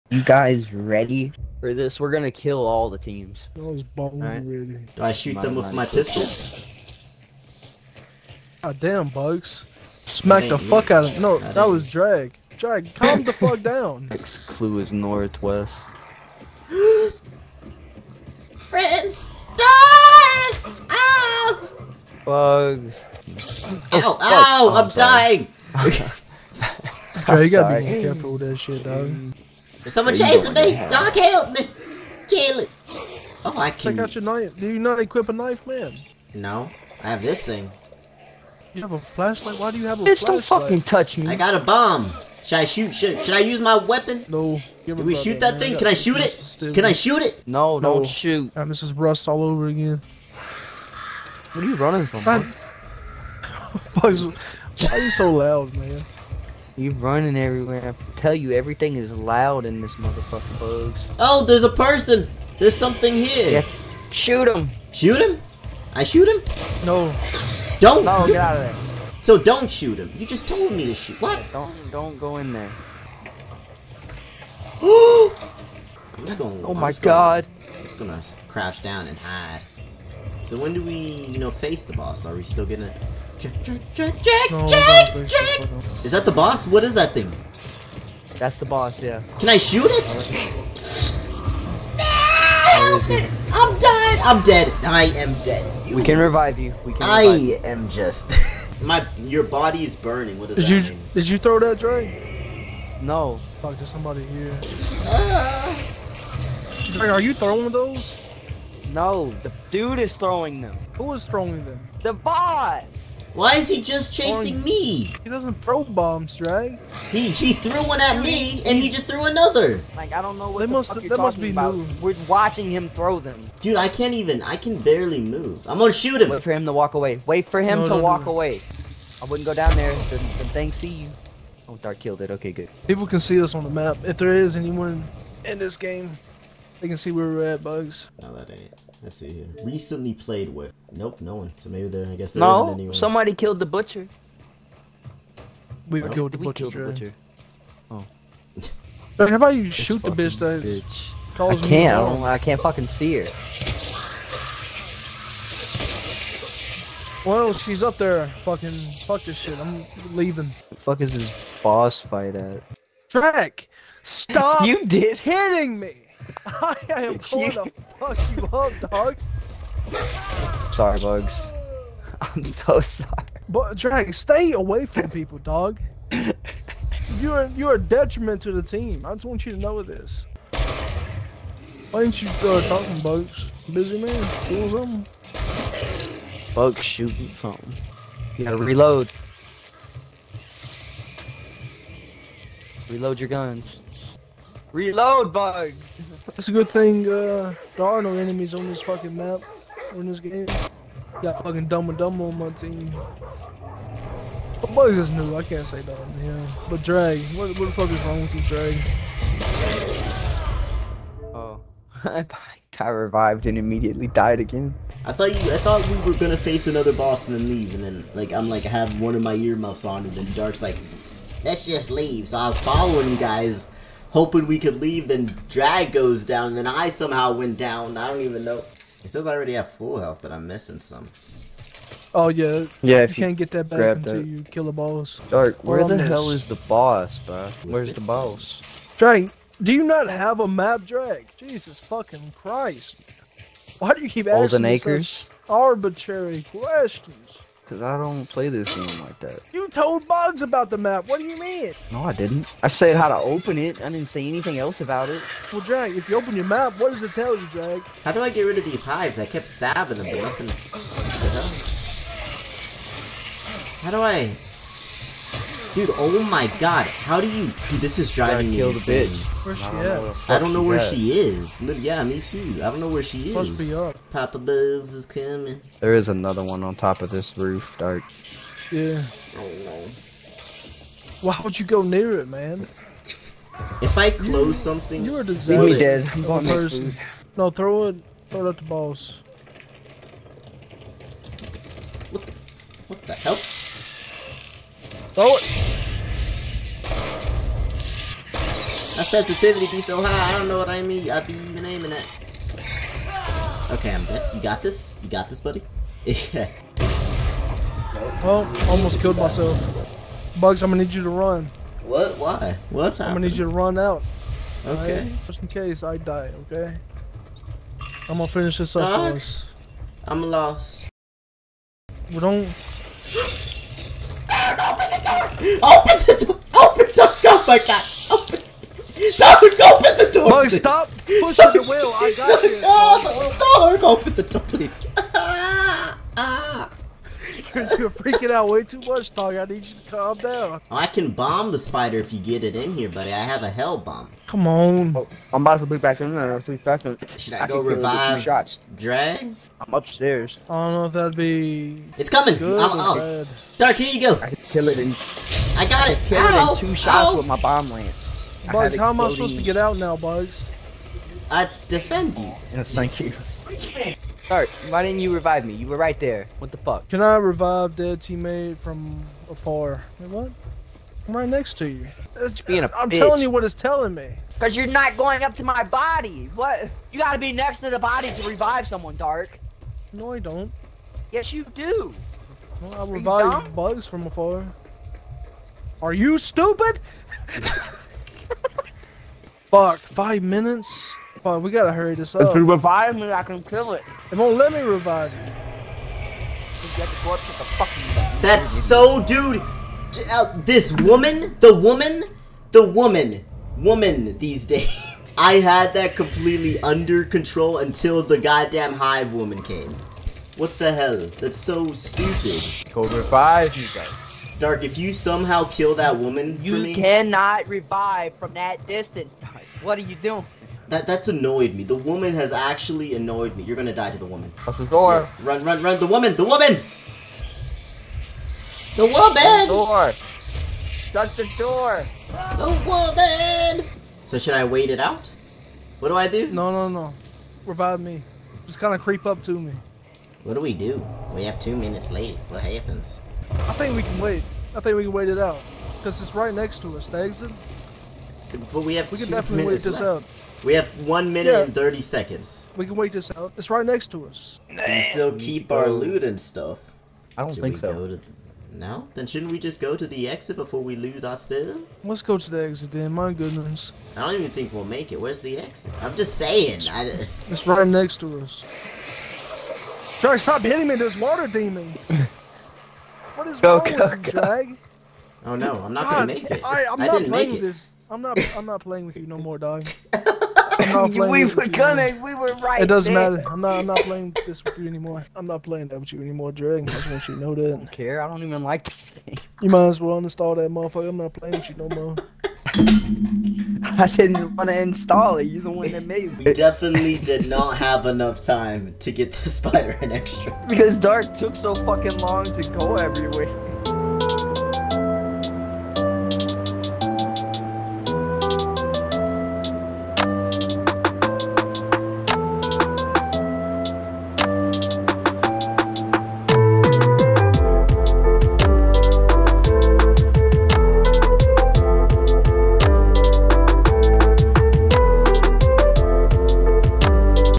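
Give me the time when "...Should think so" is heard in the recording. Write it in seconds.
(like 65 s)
457 s.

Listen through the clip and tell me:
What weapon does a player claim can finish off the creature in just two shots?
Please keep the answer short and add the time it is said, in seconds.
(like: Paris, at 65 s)
Bomb lance, at 357 s.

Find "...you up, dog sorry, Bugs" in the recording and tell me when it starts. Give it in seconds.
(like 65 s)
168 s.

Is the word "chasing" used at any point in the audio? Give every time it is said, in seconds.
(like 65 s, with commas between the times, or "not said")
30 s, 114 s.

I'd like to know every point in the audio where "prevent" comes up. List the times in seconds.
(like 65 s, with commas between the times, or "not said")
not said.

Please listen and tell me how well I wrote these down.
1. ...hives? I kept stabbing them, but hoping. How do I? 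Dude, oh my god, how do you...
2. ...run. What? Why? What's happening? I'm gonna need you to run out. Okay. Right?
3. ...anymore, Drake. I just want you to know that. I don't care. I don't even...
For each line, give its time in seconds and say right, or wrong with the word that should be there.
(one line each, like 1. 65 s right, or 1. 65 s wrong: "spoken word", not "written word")
1. 258 s wrong: "nothing", not "hoping"
2. 311 s right
3. 486 s right.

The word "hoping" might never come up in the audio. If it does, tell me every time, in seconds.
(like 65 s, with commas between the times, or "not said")
224 s.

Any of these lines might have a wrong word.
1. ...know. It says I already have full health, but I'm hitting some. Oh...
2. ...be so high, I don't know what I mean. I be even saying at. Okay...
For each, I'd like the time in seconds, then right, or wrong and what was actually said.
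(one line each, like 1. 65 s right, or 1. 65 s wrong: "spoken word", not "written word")
1. 228 s wrong: "missing", not "hitting"
2. 299 s wrong: "aiming", not "saying".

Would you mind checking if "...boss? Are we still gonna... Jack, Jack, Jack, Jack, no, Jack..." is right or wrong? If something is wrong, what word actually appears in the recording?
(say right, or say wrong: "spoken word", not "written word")
right.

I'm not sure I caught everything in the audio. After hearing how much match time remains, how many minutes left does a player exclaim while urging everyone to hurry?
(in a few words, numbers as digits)
5.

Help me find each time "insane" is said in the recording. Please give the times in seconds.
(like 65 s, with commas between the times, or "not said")
268 s.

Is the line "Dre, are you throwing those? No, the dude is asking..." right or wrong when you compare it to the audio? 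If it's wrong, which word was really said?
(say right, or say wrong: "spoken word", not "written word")
wrong: "throwing", not "asking".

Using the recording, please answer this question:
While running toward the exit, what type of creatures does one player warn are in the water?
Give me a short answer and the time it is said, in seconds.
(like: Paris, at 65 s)
Water demons, at 470 s.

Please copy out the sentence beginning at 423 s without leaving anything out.
You're gonna die to the woman.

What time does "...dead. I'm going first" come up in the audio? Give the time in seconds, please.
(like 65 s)
285 s.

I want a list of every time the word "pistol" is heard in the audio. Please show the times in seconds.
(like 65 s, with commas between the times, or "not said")
5 s.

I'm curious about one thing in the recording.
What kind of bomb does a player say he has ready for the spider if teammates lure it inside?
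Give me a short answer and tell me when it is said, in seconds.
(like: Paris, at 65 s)
Hell bomb, at 343 s.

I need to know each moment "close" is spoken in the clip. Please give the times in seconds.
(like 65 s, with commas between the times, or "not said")
284 s, 424 s.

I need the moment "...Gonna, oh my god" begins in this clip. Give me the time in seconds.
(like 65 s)
76 s.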